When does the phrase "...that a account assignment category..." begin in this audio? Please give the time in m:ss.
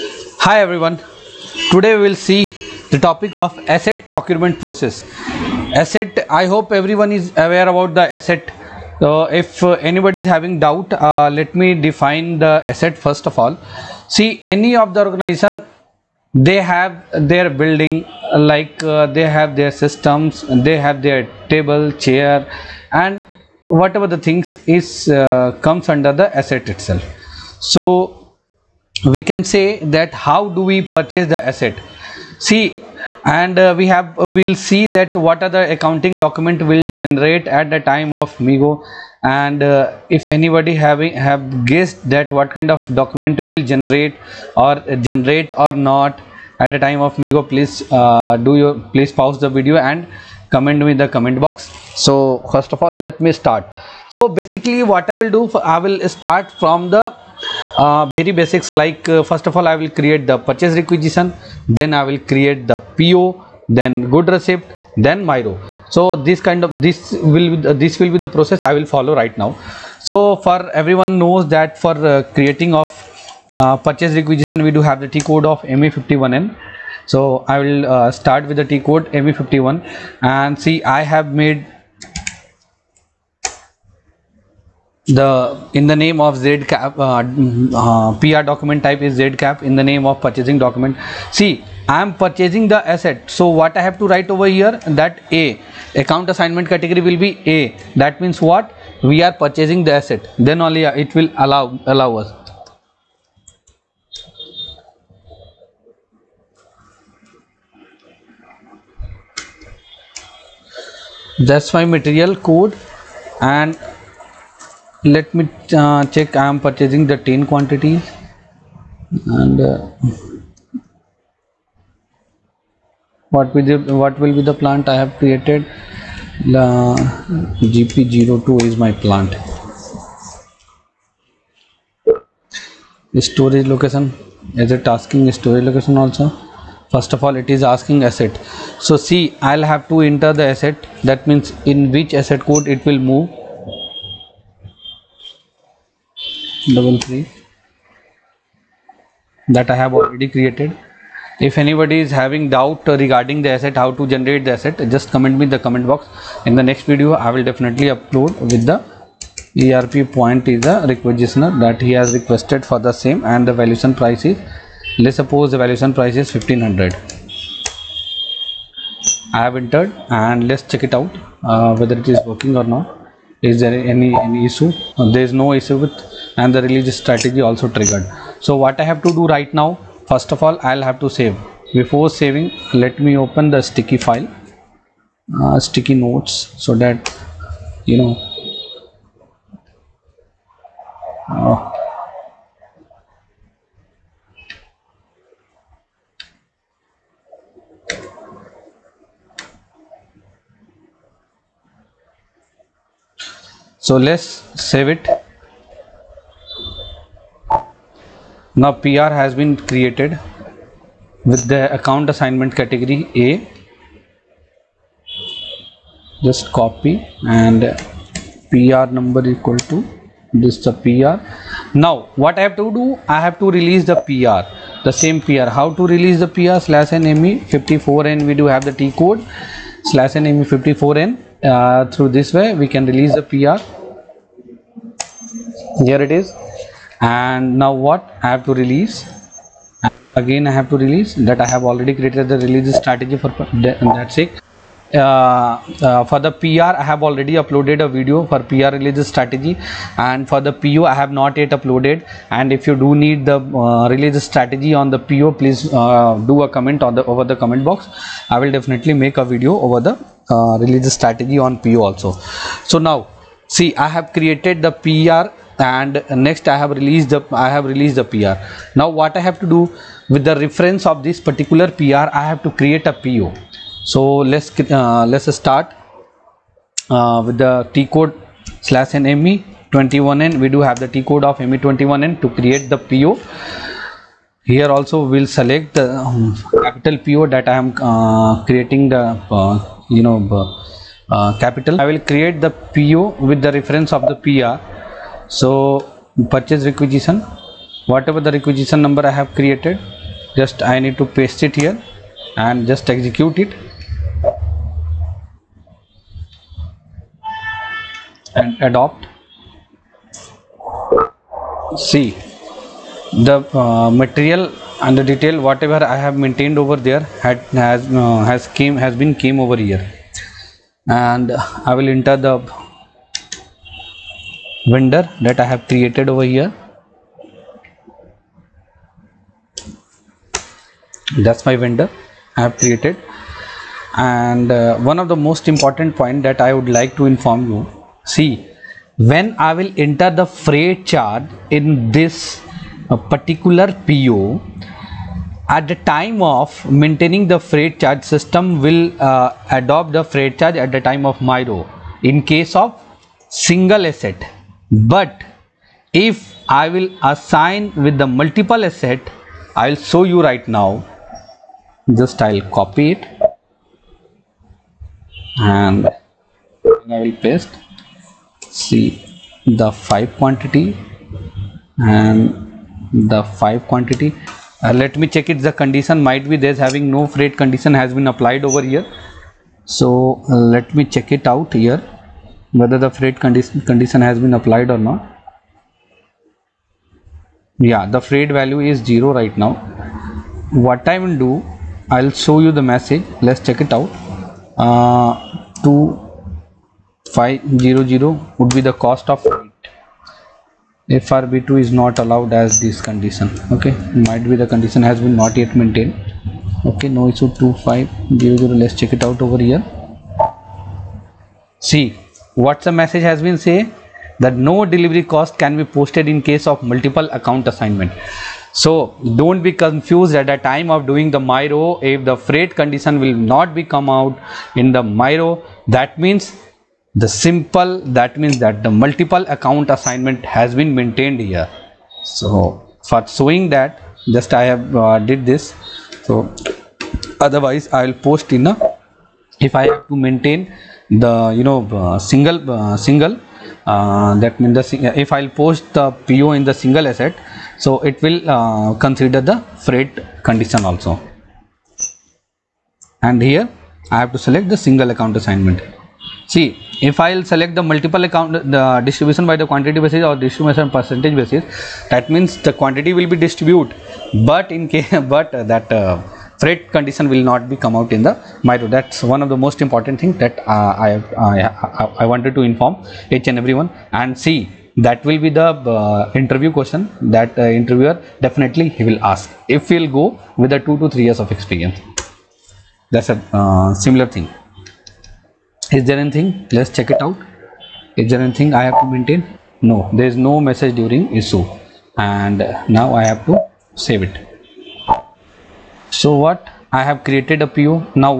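1:34.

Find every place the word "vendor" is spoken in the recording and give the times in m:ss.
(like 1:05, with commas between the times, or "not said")
5:24, 5:31.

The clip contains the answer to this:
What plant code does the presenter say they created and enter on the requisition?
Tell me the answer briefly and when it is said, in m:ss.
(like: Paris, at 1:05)
GP02, at 2:07.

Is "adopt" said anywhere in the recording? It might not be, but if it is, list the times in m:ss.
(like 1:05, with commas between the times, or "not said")
5:08, 5:49.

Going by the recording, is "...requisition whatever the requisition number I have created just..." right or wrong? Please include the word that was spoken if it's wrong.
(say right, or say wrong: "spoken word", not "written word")
right.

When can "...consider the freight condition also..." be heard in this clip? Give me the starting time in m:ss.
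7:28.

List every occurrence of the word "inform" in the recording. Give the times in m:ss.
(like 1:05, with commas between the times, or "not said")
5:37, 7:52.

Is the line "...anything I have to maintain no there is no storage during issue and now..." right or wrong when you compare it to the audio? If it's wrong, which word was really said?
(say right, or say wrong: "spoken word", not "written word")
wrong: "message", not "storage".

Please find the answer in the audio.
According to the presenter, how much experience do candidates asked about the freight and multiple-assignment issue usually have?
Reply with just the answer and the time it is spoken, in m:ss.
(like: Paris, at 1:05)
2 to 3 years, at 8:00.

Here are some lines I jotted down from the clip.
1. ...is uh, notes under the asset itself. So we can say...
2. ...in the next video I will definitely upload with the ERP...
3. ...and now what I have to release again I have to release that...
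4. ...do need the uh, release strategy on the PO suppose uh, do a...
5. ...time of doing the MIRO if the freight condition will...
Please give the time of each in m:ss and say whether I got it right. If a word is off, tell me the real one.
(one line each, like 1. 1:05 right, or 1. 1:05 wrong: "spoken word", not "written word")
1. 0:24 wrong: "comes", not "notes"
2. 2:36 right
3. 3:56 right
4. 4:12 wrong: "please", not "suppose"
5. 7:00 right.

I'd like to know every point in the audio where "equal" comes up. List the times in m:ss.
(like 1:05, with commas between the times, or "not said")
3:39.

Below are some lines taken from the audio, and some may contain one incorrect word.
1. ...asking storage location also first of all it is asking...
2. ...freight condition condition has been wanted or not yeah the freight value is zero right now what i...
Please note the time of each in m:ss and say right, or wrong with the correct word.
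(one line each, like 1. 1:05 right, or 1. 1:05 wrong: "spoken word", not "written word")
1. 2:14 right
2. 6:22 wrong: "applied", not "wanted".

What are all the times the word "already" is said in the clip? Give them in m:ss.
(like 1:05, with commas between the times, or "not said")
2:29, 4:01, 4:07.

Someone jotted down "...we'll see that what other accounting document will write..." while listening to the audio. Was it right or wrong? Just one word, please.
wrong.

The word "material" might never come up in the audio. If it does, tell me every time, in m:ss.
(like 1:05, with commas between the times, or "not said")
1:51, 5:13.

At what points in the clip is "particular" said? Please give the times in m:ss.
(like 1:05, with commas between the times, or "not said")
4:31, 5:42.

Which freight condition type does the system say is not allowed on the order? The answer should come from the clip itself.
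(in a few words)
FRB2.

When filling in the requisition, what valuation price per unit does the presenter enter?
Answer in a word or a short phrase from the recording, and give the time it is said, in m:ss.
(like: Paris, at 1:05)
1500, at 2:46.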